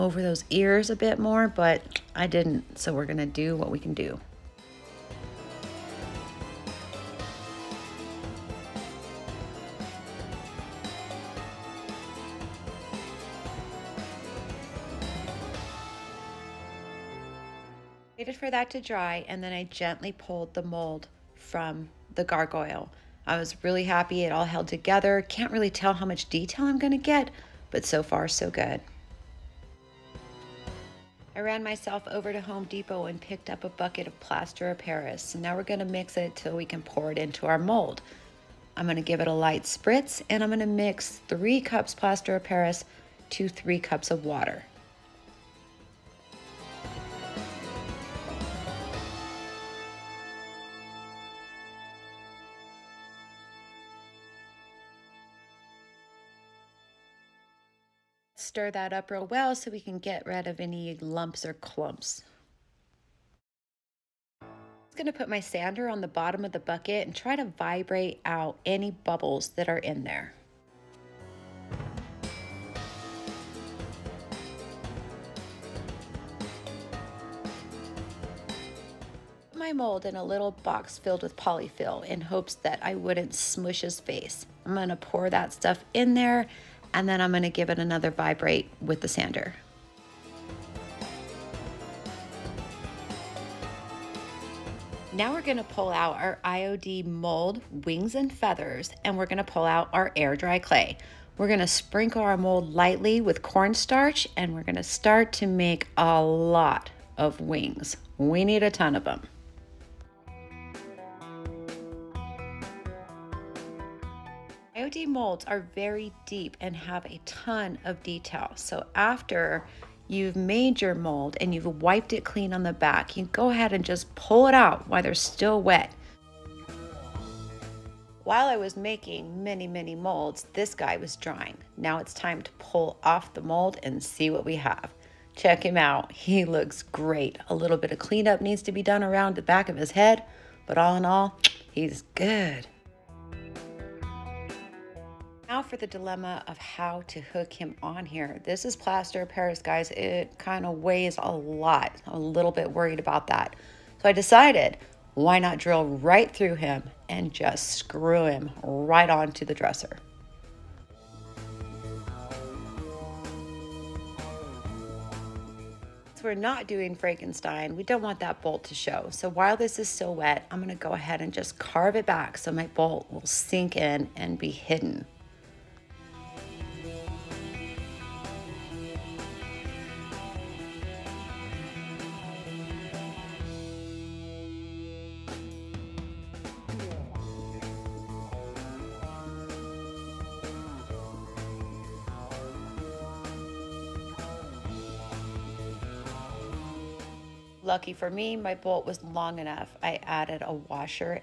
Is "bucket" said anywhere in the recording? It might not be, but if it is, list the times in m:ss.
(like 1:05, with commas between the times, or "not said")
0:33, 1:06.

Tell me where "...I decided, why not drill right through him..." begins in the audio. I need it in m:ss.
2:34.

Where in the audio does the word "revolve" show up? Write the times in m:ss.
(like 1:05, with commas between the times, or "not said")
not said.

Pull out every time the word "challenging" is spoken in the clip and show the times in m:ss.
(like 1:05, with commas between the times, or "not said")
not said.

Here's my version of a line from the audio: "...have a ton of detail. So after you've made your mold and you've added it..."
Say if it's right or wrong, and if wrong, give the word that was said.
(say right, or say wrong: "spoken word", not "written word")
wrong: "wiped", not "added".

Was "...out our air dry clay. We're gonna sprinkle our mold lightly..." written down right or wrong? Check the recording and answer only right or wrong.
right.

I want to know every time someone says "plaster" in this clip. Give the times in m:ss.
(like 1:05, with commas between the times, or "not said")
0:34, 0:41, 2:28.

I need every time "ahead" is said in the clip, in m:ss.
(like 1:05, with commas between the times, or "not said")
2:03, 2:50.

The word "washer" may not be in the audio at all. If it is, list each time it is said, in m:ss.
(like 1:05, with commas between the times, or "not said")
3:20.